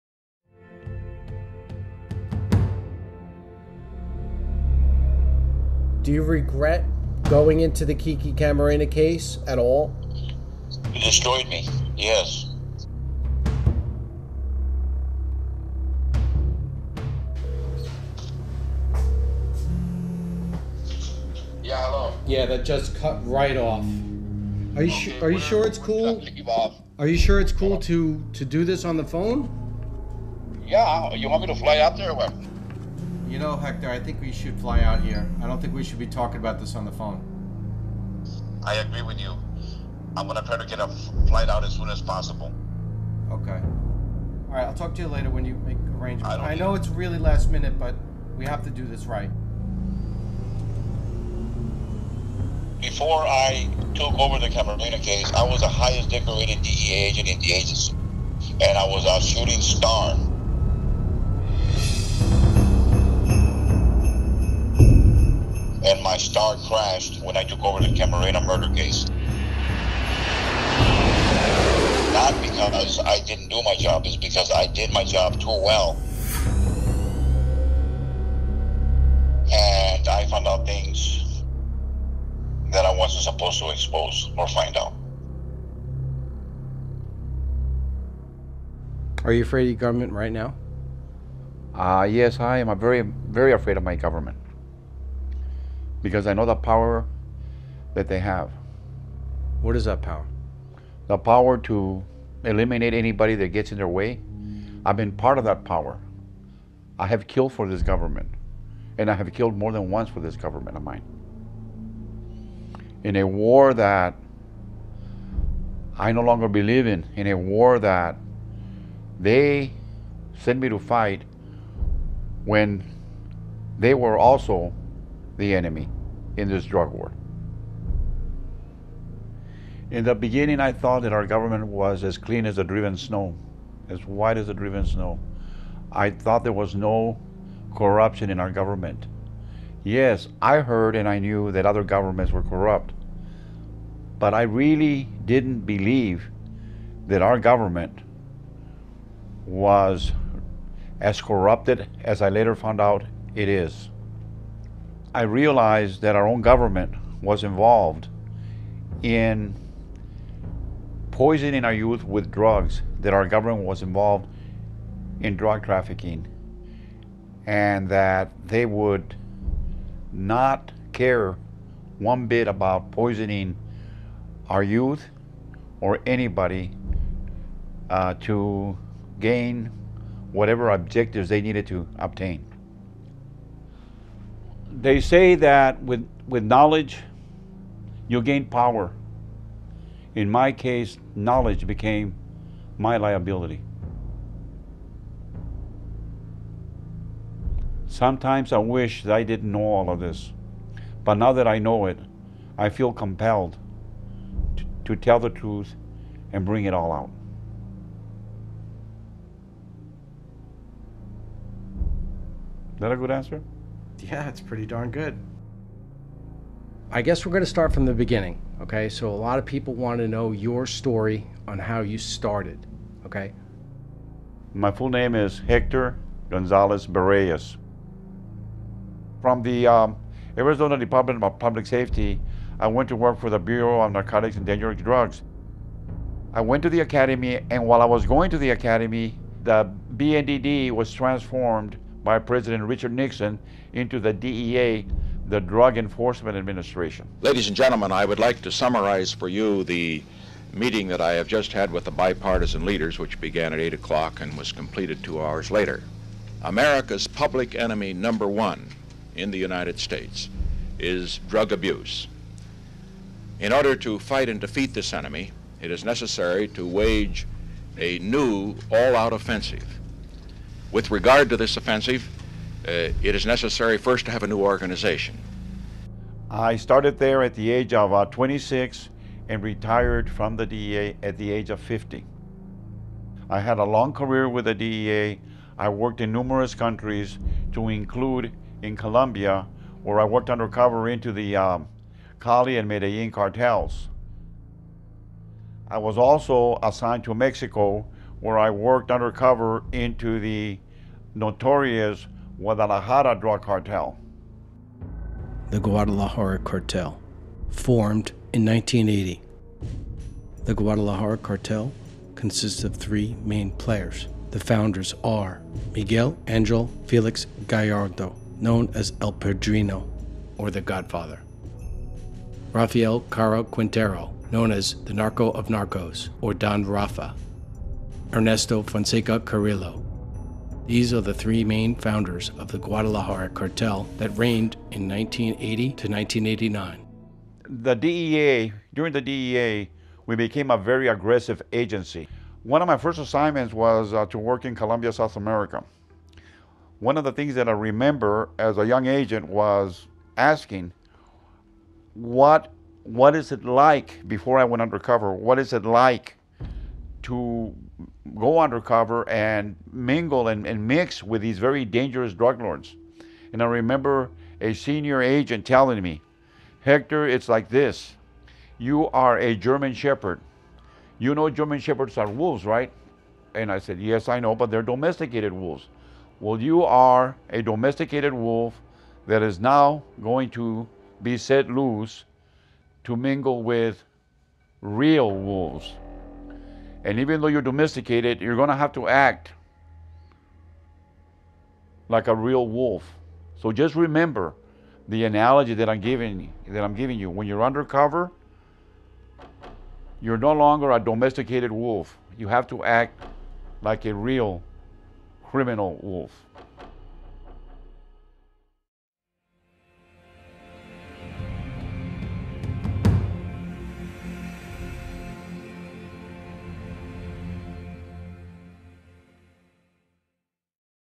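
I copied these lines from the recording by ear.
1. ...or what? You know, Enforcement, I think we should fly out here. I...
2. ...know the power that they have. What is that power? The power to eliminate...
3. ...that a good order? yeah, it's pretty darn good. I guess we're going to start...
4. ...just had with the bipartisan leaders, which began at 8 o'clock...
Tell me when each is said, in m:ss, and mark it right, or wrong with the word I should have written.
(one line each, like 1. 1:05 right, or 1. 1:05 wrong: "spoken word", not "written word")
1. 0:32 wrong: "Hector", not "Enforcement"
2. 1:36 right
3. 3:32 wrong: "answer", not "order"
4. 4:11 right.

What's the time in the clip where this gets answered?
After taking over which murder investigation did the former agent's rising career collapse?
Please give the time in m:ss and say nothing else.
1:07.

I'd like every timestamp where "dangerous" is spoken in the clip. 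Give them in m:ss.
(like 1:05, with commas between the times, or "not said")
3:54, 6:01.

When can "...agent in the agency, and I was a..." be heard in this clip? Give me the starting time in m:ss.
0:56.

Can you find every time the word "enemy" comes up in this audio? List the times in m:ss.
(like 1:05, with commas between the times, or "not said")
2:05, 4:17, 4:24.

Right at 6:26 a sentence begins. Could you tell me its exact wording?
And even though you're domesticated, you're going to have to act like a real wolf.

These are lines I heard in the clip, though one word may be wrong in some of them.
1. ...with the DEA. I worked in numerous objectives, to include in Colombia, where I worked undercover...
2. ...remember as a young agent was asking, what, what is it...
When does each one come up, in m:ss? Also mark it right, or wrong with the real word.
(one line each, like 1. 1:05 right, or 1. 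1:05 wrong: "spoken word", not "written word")
1. 4:44 wrong: "countries", not "objectives"
2. 5:47 right.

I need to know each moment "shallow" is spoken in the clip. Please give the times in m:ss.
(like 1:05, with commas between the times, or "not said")
not said.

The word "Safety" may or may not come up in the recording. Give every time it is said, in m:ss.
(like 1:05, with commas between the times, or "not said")
3:51.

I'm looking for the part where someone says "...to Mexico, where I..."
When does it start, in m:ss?
4:57.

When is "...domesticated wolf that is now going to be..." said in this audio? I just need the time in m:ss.
6:17.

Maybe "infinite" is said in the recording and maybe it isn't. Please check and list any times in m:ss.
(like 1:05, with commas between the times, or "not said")
not said.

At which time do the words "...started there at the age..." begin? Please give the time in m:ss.
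4:36.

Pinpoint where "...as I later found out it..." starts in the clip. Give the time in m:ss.
2:32.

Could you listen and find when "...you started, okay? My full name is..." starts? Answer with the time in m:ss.
3:41.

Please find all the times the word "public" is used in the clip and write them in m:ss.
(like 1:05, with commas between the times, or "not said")
3:51, 4:17.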